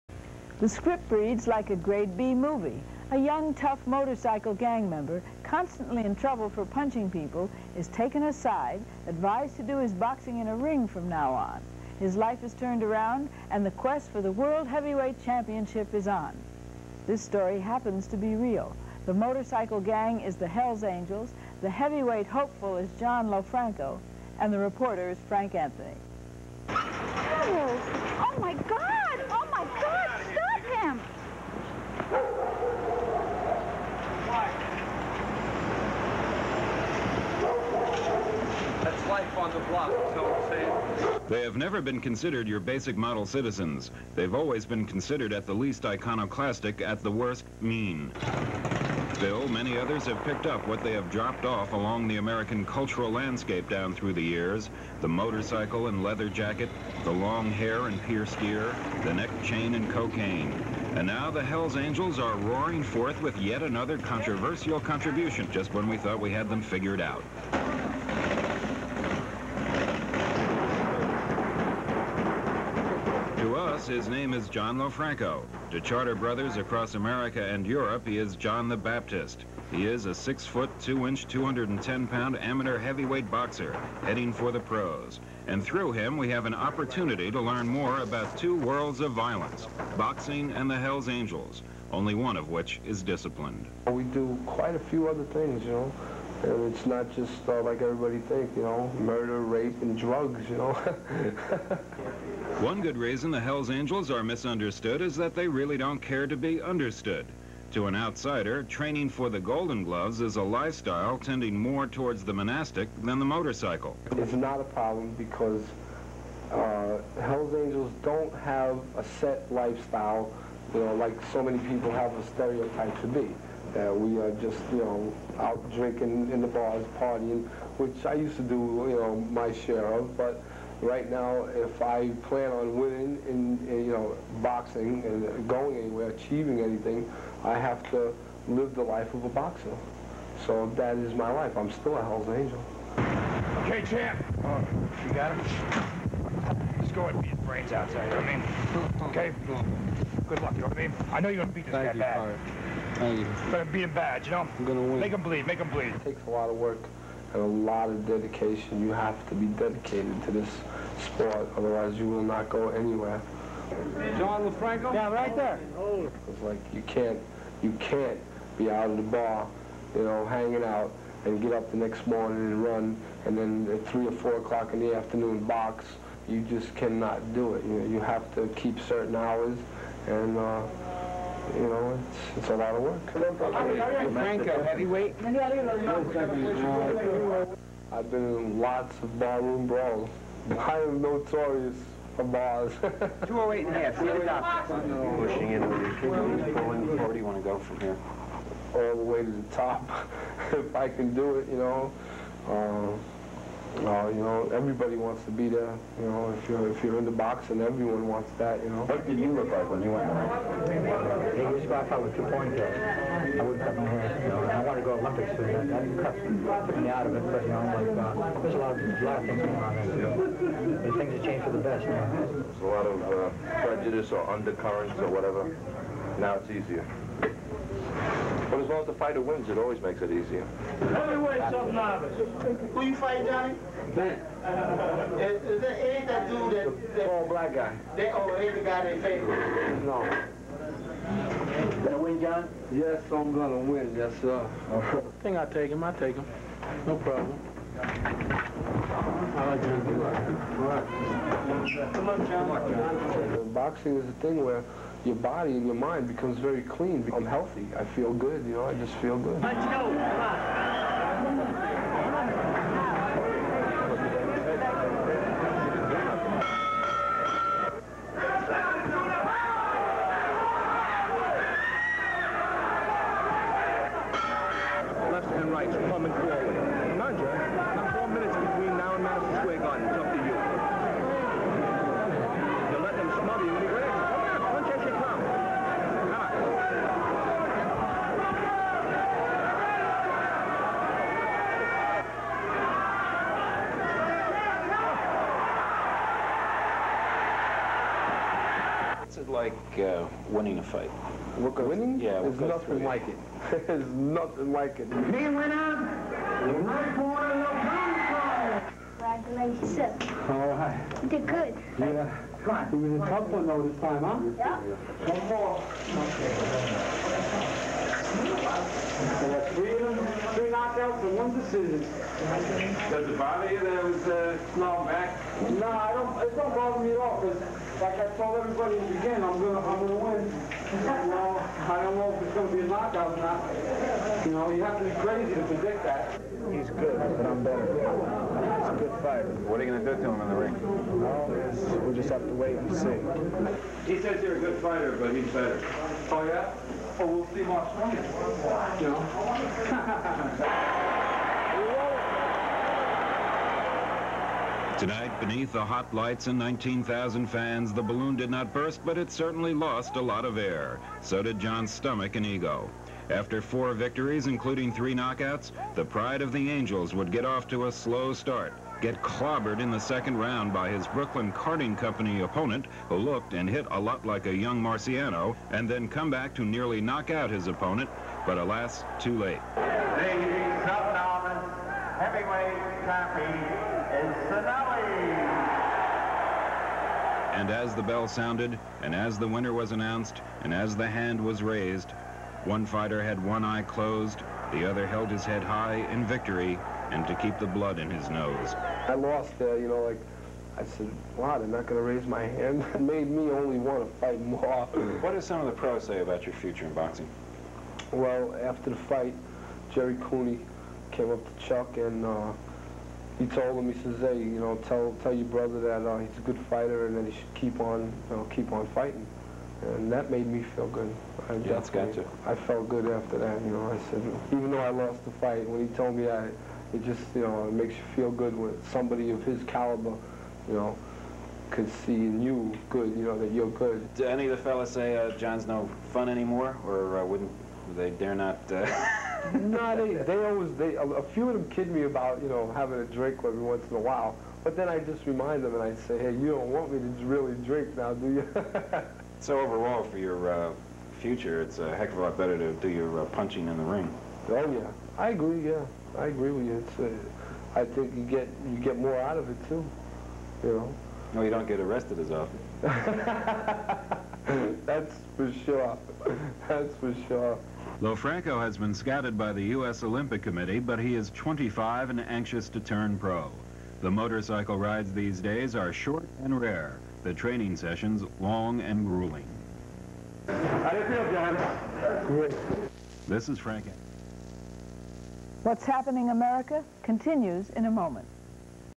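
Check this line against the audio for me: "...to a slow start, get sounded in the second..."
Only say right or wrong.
wrong.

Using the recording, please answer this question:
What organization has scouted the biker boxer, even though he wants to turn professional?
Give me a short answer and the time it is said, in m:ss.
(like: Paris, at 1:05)
U.S. Olympic Committee, at 7:49.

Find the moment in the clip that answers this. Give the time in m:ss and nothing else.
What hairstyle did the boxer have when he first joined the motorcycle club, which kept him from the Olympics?
3:32.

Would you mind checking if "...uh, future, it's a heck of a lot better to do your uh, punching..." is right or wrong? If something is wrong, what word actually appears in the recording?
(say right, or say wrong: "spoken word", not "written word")
right.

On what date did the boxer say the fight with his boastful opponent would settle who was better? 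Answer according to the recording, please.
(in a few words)
March 20.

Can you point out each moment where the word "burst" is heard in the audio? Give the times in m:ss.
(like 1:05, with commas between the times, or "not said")
5:58.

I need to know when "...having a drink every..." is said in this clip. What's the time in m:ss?
7:22.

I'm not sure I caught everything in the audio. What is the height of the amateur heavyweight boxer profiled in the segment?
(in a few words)
6 feet 2 inches.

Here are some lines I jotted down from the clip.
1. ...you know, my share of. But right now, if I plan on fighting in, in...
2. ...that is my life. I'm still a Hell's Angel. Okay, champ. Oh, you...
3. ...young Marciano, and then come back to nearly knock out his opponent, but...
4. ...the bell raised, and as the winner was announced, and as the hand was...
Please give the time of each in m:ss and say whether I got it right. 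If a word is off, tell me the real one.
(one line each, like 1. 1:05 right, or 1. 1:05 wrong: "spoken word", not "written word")
1. 2:08 wrong: "winning", not "fighting"
2. 2:20 right
3. 6:14 right
4. 6:27 wrong: "sounded", not "raised".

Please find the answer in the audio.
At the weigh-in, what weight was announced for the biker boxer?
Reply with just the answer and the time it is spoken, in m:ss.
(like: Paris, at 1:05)
208 and a half, at 3:13.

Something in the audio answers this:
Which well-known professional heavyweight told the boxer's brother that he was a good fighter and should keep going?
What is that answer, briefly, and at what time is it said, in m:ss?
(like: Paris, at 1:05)
Jerry Cooney, at 6:49.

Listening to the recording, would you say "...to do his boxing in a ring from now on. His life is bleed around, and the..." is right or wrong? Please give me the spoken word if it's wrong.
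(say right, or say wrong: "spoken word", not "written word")
wrong: "turned", not "bleed".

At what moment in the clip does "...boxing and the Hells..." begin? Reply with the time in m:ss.
1:29.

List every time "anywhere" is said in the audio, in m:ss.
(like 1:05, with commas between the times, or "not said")
2:15, 2:42.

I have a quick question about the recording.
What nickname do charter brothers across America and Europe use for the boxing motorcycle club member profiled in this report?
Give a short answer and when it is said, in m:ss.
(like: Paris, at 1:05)
John the Baptist, at 1:18.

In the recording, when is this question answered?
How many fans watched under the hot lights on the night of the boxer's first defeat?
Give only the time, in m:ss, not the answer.
5:56.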